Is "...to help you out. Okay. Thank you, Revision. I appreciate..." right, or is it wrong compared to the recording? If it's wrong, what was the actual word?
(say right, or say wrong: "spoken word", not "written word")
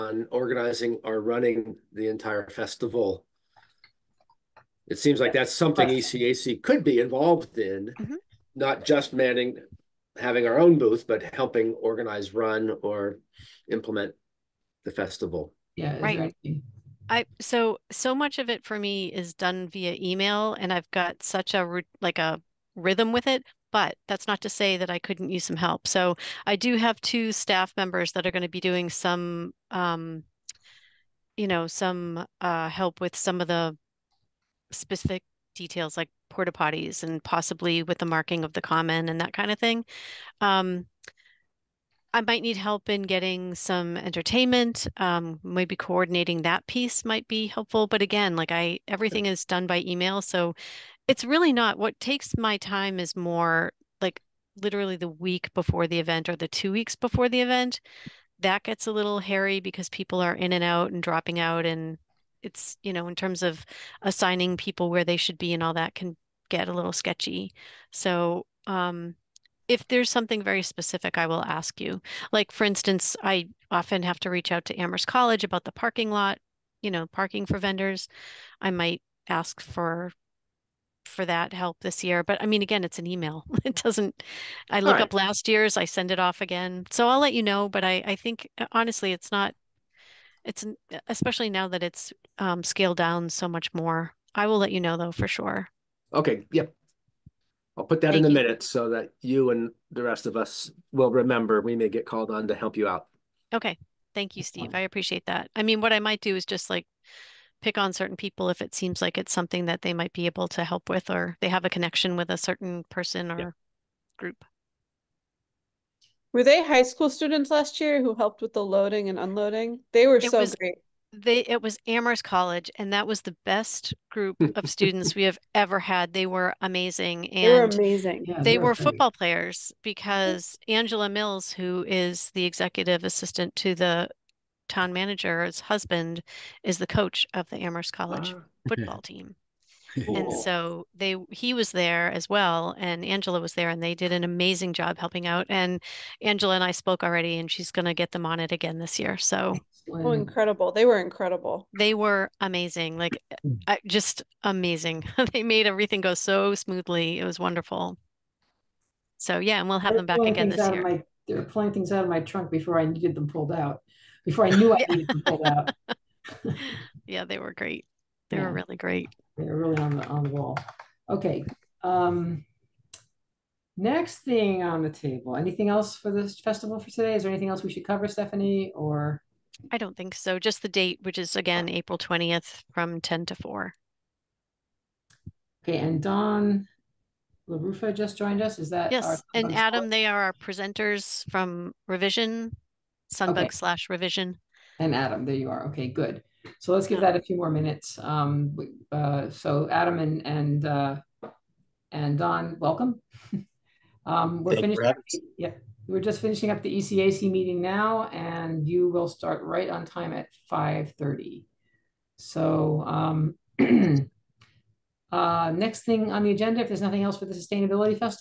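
wrong: "Steve", not "Revision".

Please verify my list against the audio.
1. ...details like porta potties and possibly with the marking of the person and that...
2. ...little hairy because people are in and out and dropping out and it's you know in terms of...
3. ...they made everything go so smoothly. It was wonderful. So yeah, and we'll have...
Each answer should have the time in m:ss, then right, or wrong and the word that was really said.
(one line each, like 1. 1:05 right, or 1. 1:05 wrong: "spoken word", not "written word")
1. 0:35 wrong: "common", not "person"
2. 0:58 right
3. 2:35 right.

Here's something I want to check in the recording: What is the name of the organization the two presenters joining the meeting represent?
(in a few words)
Revision Sunbug.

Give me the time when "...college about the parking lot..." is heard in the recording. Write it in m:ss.
1:15.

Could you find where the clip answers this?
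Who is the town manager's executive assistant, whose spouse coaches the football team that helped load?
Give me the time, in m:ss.
2:10.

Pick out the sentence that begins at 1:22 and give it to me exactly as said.
But I mean, again, it's an email.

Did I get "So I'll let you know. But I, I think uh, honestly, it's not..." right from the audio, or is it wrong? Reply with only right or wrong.
right.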